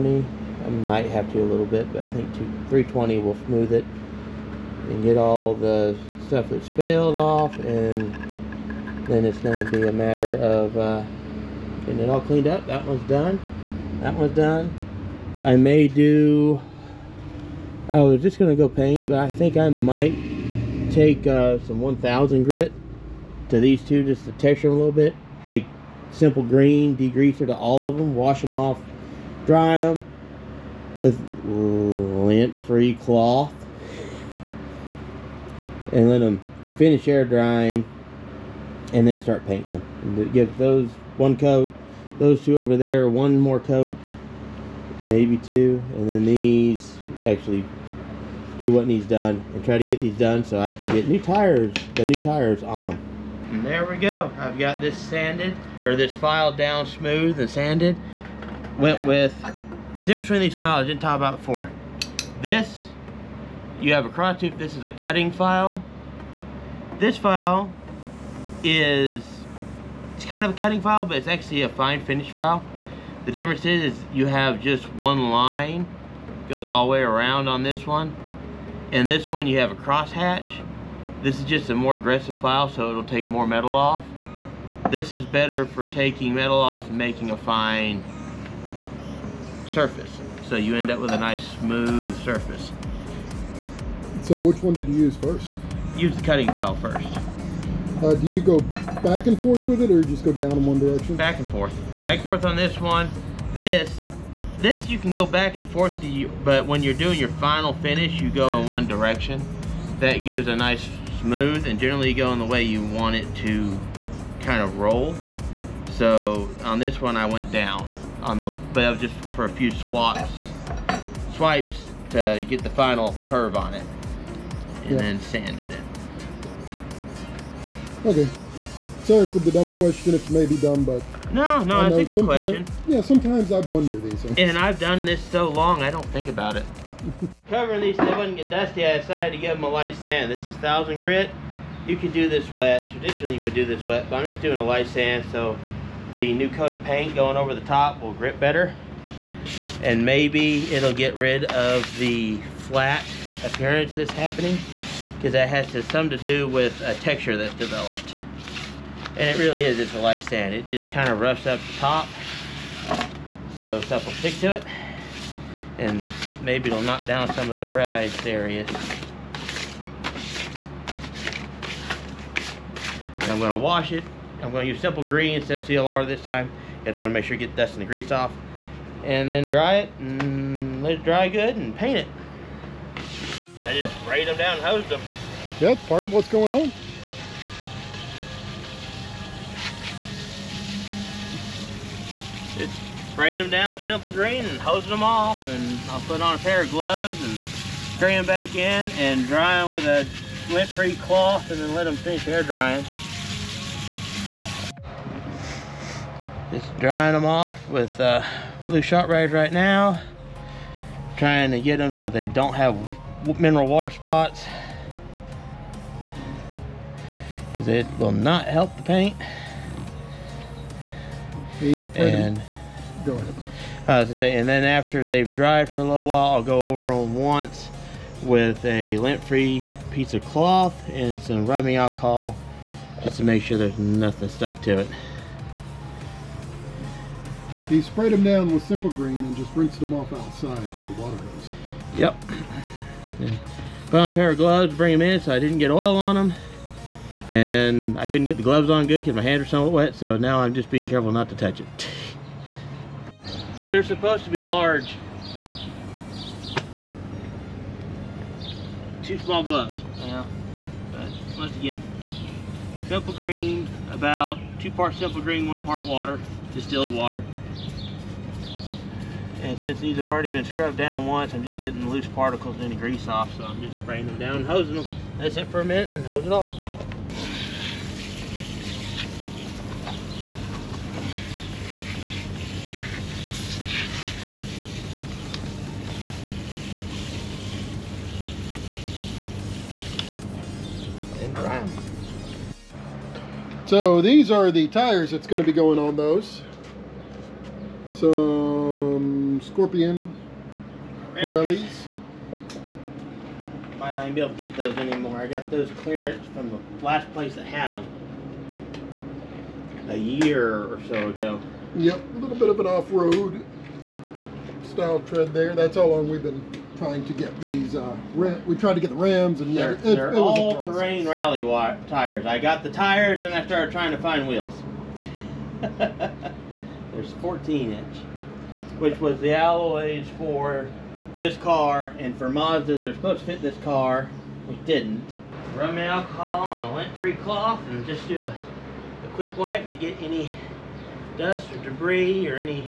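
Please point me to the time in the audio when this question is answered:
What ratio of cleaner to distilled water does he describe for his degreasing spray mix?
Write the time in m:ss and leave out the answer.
4:24.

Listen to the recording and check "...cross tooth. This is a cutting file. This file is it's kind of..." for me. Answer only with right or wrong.
right.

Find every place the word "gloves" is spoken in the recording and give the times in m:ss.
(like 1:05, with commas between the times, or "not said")
3:16, 4:04, 4:08, 4:19.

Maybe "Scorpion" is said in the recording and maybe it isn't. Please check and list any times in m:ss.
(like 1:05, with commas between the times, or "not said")
4:59.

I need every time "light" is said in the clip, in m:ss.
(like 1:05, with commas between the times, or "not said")
2:19, 2:24, 2:39.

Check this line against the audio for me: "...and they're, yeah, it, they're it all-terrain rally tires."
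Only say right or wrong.
right.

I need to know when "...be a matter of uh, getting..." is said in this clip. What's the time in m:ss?
0:09.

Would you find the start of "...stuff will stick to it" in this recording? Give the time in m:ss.
2:43.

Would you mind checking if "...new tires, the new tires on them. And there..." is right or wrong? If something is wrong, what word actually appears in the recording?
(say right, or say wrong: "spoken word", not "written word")
right.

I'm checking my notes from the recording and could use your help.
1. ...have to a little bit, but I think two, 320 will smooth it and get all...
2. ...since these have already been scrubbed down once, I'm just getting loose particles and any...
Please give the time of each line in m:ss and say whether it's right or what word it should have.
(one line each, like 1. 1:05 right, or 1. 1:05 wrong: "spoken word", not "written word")
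1. 0:01 right
2. 4:29 right.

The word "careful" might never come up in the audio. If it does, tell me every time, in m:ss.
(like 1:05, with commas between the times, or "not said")
4:10.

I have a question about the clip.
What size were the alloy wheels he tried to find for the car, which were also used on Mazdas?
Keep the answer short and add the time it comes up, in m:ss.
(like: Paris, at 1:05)
14 inch, at 5:27.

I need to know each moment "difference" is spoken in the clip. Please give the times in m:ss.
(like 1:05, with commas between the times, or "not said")
1:00, 1:13.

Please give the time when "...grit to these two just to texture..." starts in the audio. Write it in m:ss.
0:22.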